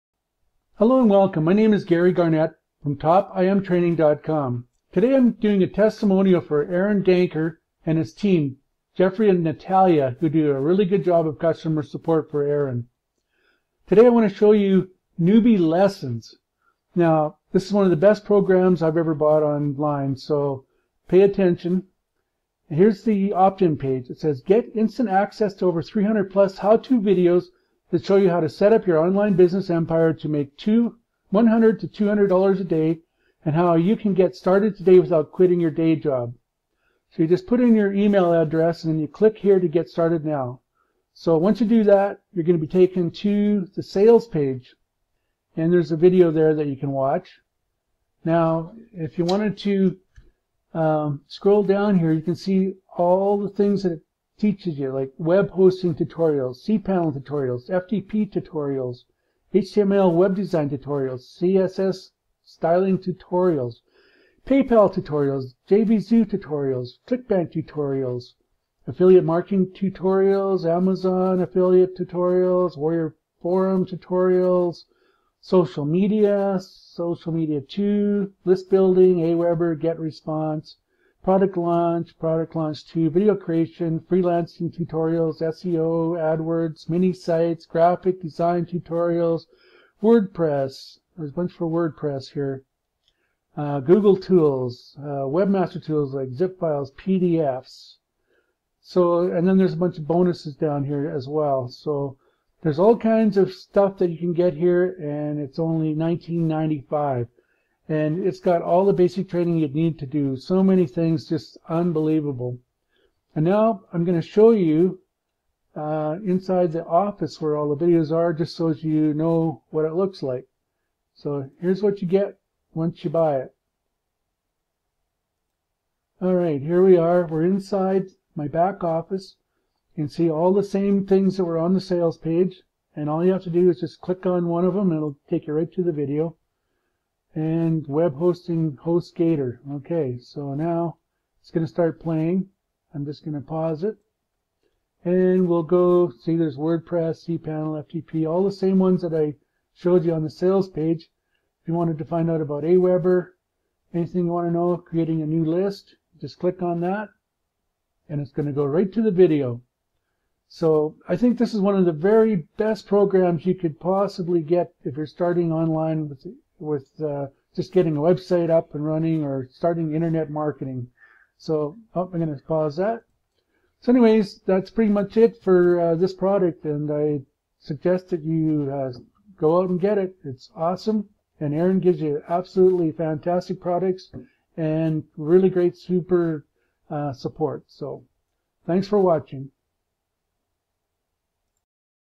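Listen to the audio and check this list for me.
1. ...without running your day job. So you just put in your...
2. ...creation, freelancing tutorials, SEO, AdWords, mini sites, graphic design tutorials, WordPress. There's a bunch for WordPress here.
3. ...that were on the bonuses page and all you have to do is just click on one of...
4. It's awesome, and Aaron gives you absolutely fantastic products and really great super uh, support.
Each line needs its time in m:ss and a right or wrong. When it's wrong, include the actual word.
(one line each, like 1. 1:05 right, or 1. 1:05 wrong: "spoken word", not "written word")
1. 0:34 wrong: "quitting", not "running"
2. 1:23 right
3. 2:11 wrong: "sales", not "bonuses"
4. 3:00 right.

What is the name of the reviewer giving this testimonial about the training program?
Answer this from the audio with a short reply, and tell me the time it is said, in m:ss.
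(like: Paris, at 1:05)
Gary Garnett, at 0:01.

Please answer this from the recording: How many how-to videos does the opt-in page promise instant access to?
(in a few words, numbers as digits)
300.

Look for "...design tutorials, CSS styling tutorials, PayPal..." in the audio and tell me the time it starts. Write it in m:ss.
1:00.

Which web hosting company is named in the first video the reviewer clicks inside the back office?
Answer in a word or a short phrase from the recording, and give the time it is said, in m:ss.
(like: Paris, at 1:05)
HostGator, at 2:18.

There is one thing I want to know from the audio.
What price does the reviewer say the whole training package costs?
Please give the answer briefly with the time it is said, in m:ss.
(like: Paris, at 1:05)
$19.95, at 1:45.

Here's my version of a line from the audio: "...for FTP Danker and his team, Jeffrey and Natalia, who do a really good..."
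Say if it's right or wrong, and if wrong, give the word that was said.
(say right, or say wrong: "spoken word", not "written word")
wrong: "Aaron", not "FTP".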